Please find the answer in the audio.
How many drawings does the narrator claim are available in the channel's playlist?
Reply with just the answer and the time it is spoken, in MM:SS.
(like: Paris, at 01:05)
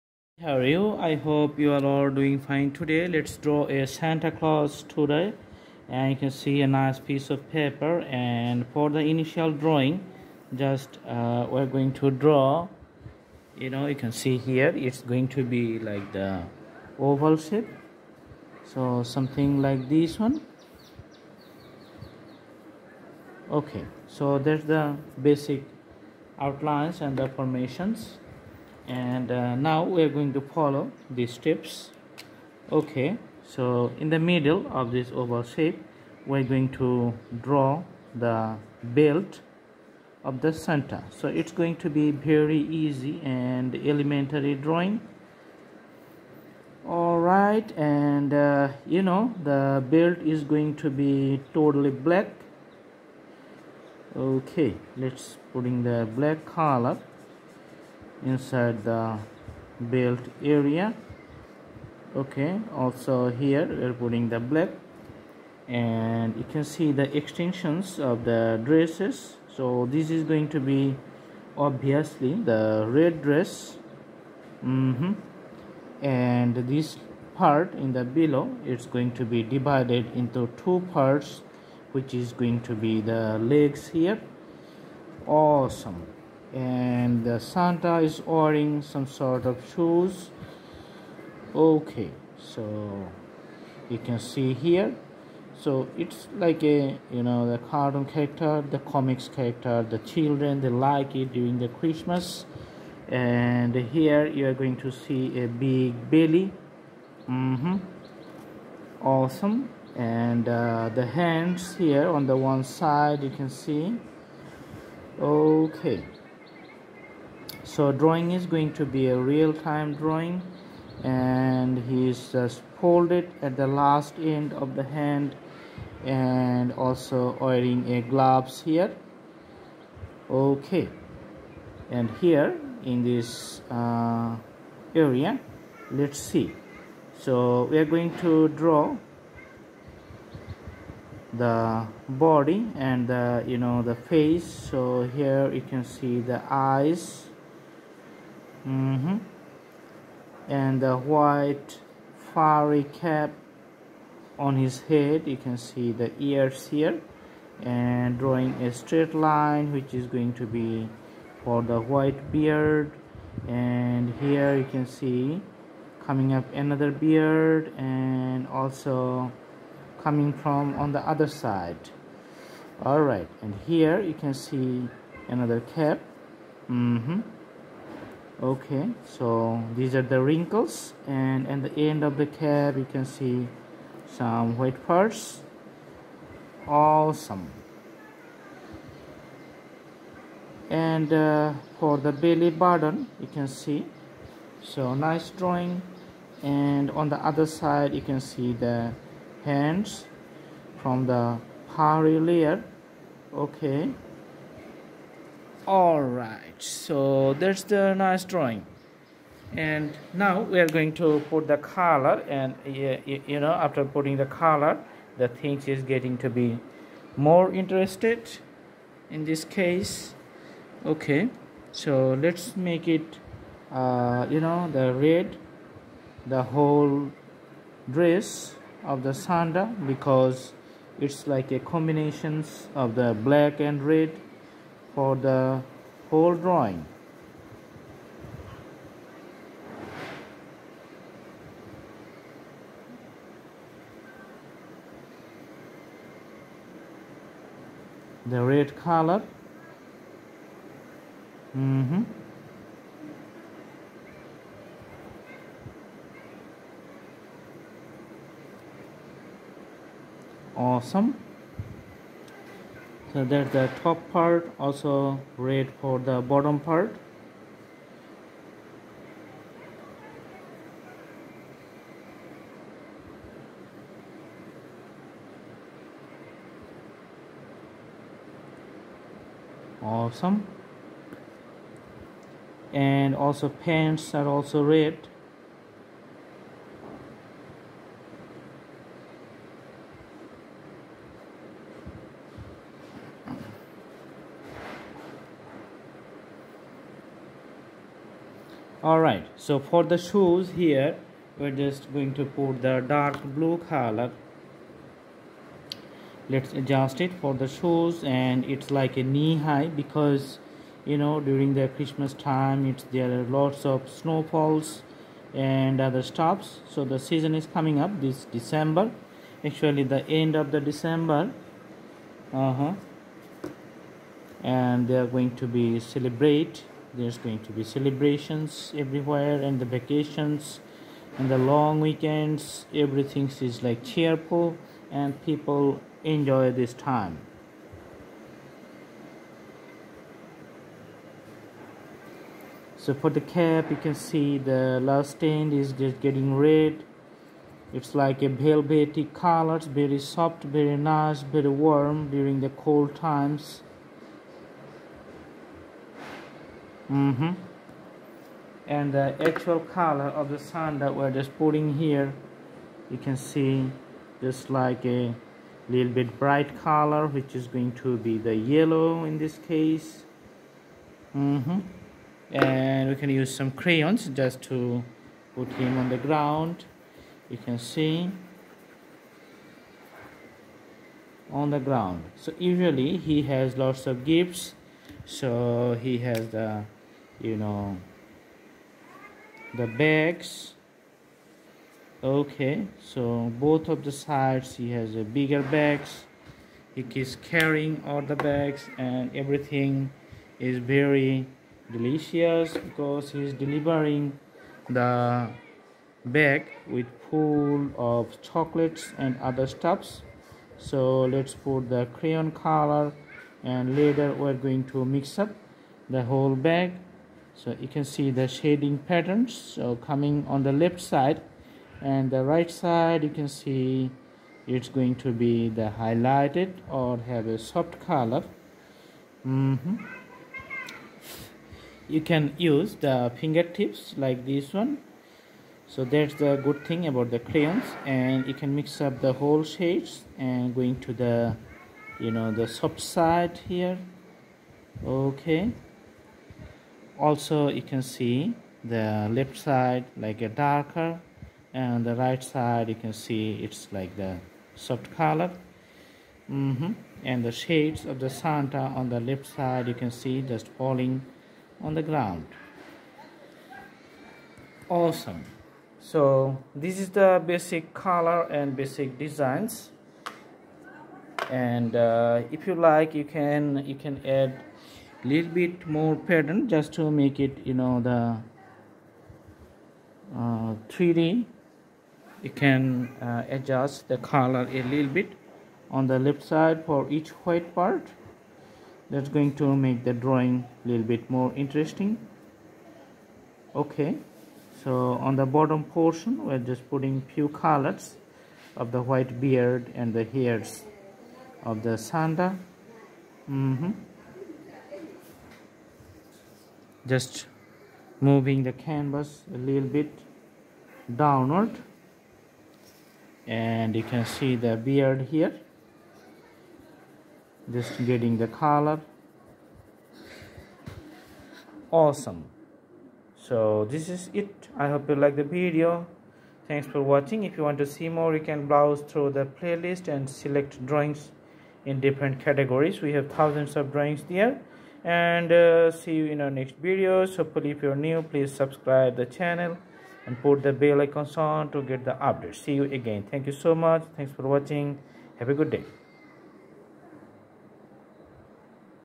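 Thousands, at 08:53.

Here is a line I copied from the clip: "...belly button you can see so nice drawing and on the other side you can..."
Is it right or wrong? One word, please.
right.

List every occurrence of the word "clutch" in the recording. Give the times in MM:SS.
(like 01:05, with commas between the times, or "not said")
not said.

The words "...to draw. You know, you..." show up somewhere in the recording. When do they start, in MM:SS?
00:11.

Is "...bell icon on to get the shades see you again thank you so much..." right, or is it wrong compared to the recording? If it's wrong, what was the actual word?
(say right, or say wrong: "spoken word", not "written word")
wrong: "updates", not "shades".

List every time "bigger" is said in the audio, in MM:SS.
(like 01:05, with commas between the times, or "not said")
06:35.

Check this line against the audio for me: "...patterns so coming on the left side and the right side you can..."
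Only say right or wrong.
right.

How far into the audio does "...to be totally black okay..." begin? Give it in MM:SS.
00:50.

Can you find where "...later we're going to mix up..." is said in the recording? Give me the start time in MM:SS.
06:53.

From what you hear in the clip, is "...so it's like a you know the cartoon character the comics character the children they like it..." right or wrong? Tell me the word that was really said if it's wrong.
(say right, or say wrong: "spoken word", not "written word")
right.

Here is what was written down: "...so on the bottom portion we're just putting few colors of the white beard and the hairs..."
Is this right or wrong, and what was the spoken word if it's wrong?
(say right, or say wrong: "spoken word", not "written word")
right.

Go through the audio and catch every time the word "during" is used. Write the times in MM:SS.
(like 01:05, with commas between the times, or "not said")
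01:41, 05:11, 05:52.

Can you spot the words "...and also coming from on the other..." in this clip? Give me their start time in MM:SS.
02:47.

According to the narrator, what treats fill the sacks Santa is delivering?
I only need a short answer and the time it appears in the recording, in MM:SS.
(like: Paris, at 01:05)
Chocolates, at 06:48.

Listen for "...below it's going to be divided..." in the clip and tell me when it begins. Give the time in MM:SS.
01:18.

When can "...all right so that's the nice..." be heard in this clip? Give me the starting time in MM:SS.
03:25.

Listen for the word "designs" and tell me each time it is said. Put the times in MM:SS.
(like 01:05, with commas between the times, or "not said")
07:48.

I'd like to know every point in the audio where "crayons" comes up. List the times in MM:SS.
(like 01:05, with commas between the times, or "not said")
06:13, 06:51, 07:17.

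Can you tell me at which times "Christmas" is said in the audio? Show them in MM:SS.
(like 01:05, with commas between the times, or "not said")
01:41, 05:11.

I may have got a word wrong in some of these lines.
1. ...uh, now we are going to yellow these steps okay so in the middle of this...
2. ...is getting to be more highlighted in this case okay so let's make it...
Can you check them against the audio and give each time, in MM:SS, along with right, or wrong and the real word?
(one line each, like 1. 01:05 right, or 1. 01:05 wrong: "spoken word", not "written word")
1. 00:29 wrong: "follow", not "yellow"
2. 03:35 wrong: "interested", not "highlighted".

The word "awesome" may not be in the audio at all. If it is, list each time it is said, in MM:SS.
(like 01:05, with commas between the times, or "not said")
01:25, 01:49, 03:06, 04:20, 04:39, 07:44, 08:41.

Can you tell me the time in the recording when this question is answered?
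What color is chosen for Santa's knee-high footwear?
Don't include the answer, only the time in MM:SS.
05:02.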